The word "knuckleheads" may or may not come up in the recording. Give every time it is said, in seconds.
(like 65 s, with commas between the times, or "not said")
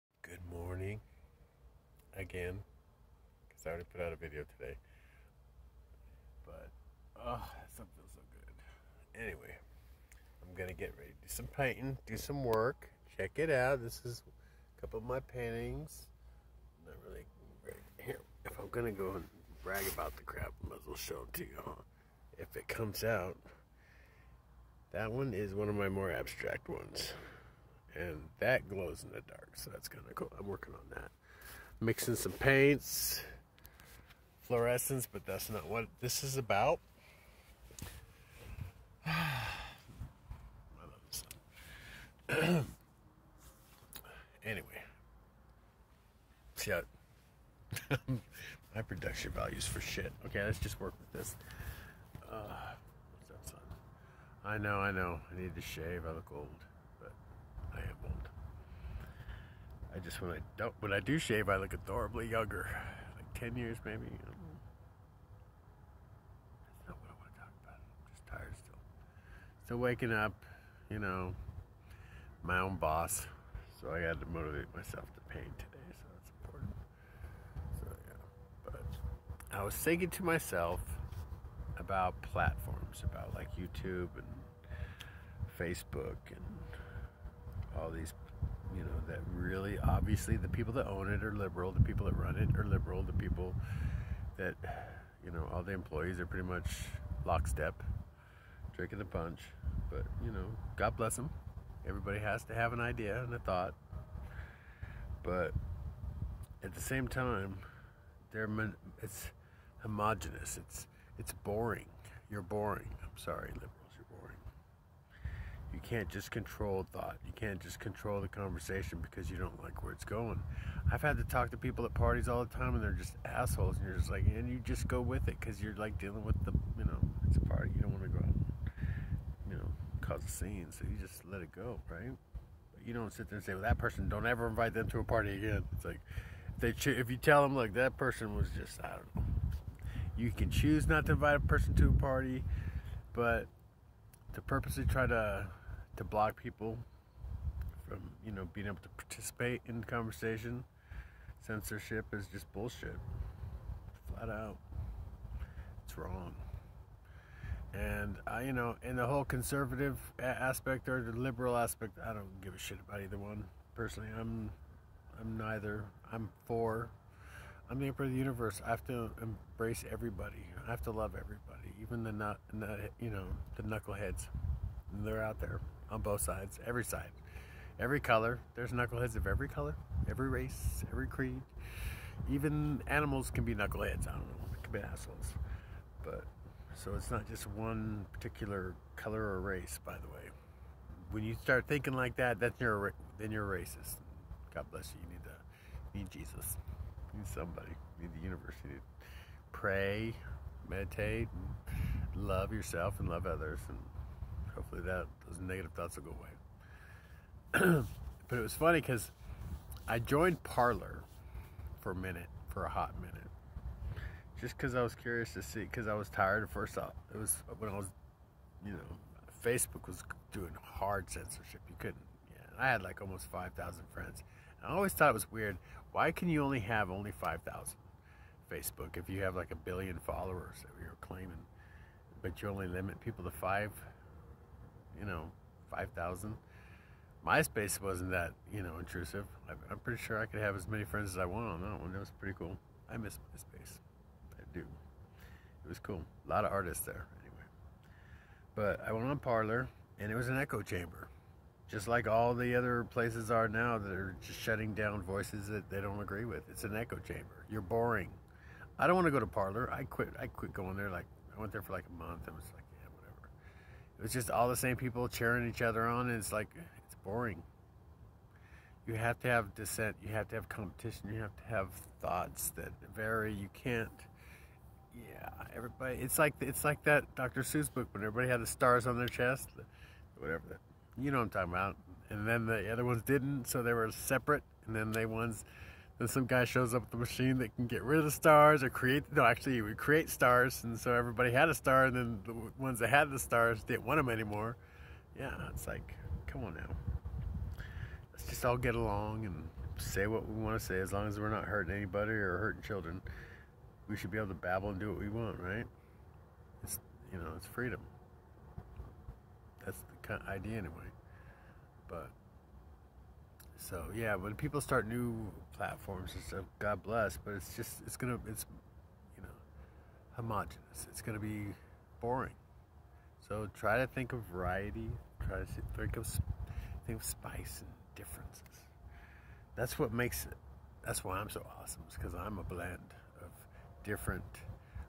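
173 s, 178 s, 183 s.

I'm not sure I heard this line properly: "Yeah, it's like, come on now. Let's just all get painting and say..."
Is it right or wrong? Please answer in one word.
wrong.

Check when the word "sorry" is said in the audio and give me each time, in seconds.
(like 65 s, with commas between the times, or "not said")
113 s.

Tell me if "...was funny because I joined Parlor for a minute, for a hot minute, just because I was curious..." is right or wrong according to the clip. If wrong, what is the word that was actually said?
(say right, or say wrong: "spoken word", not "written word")
right.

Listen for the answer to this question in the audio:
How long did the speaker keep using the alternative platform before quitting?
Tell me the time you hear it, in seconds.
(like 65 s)
261 s.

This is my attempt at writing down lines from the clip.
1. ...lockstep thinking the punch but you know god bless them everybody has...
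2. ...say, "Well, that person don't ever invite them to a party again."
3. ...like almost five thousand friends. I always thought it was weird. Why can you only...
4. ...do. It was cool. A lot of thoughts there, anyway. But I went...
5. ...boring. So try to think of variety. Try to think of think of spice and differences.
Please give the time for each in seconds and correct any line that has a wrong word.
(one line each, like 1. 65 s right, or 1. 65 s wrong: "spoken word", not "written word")
1. 97 s wrong: "drinking", not "thinking"
2. 133 s right
3. 222 s right
4. 244 s wrong: "artists", not "thoughts"
5. 322 s right.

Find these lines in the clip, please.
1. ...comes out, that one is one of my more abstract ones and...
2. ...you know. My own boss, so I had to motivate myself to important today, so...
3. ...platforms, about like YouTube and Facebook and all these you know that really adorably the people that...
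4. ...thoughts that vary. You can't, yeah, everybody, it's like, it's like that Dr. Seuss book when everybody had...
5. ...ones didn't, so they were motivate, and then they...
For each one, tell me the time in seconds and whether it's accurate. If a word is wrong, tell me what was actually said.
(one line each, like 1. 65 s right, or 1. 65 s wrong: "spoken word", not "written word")
1. 22 s right
2. 70 s wrong: "paint", not "important"
3. 82 s wrong: "obviously", not "adorably"
4. 272 s right
5. 282 s wrong: "separate", not "motivate".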